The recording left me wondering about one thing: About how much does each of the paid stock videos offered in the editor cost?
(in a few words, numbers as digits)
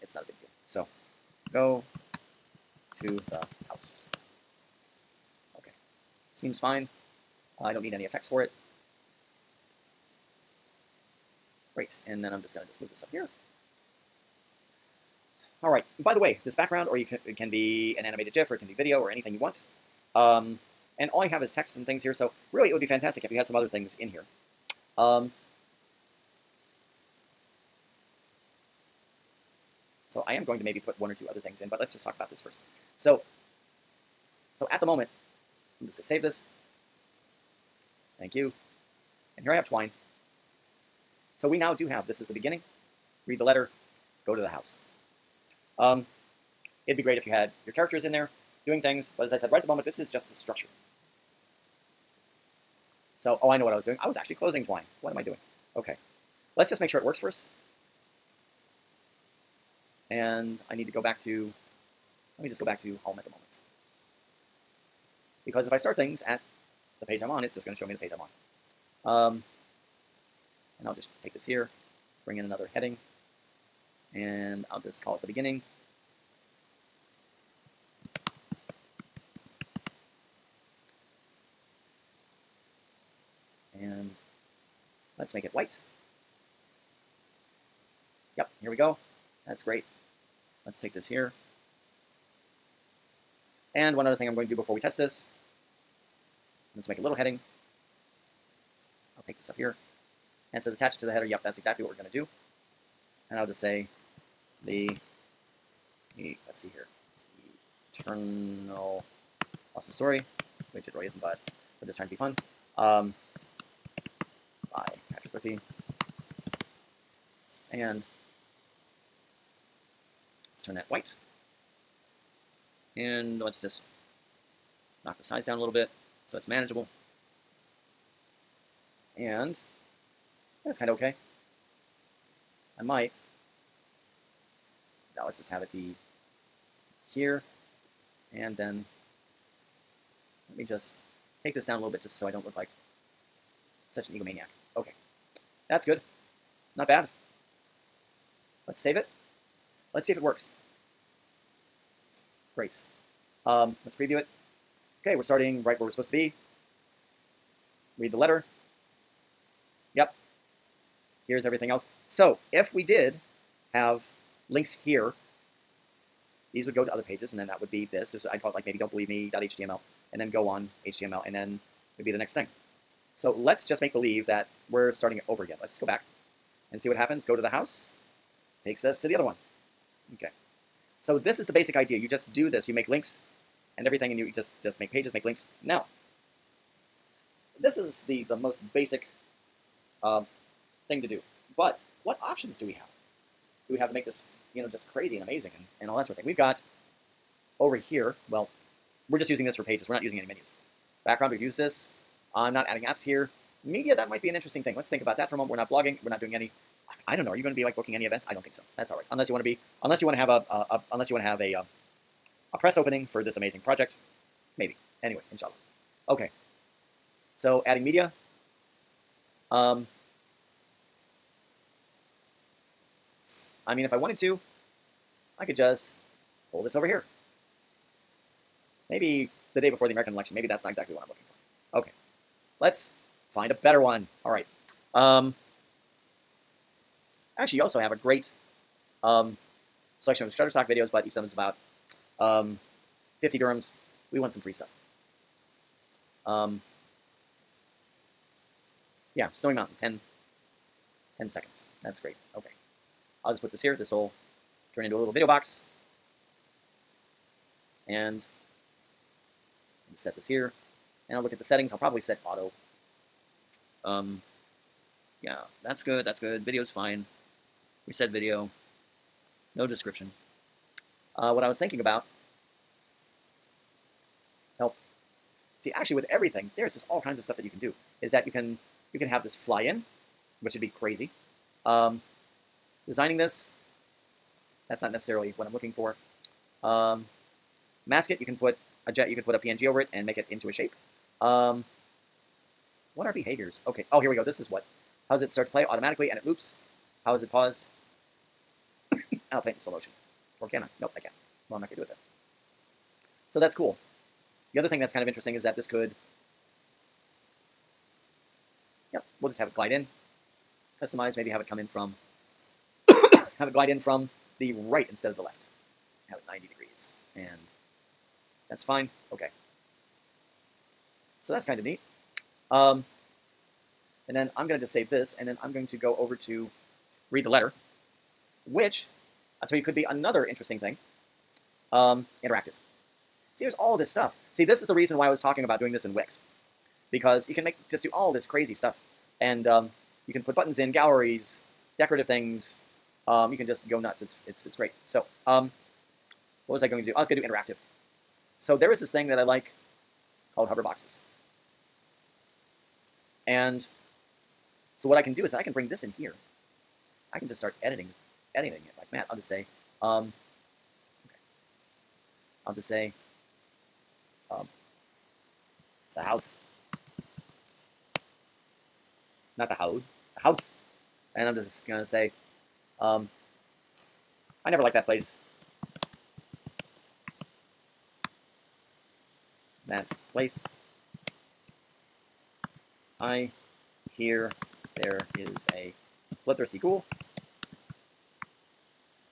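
50 dirhams.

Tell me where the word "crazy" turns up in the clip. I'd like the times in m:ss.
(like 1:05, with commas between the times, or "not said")
3:14, 4:40, 5:38.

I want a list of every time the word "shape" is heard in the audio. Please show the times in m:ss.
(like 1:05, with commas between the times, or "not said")
4:50.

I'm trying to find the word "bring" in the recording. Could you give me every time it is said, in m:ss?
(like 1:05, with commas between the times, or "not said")
1:12, 5:55.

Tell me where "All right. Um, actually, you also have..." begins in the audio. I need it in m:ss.
3:54.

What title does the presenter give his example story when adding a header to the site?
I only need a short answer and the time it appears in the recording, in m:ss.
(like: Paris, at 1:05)
Eternal awesome story, at 1:47.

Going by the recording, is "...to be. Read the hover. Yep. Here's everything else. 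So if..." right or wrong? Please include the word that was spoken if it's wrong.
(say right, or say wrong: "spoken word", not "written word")
wrong: "letter", not "hover".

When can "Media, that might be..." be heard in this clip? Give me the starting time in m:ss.
3:23.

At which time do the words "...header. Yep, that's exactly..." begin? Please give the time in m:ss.
1:41.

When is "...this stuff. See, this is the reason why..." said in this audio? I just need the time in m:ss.
5:33.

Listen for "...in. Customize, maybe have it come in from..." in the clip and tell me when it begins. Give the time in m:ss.
5:09.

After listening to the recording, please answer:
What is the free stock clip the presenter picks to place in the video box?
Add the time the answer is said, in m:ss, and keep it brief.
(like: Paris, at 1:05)
Snowy Mountain, at 4:09.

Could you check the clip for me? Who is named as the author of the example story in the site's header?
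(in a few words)
Patrick Lichty.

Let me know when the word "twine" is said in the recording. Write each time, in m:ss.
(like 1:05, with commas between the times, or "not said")
0:39, 0:54.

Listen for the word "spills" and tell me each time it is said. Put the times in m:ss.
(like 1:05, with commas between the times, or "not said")
not said.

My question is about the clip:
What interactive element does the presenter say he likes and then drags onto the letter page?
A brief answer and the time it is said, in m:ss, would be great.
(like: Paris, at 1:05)
Hover boxes, at 5:50.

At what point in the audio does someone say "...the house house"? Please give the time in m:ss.
6:09.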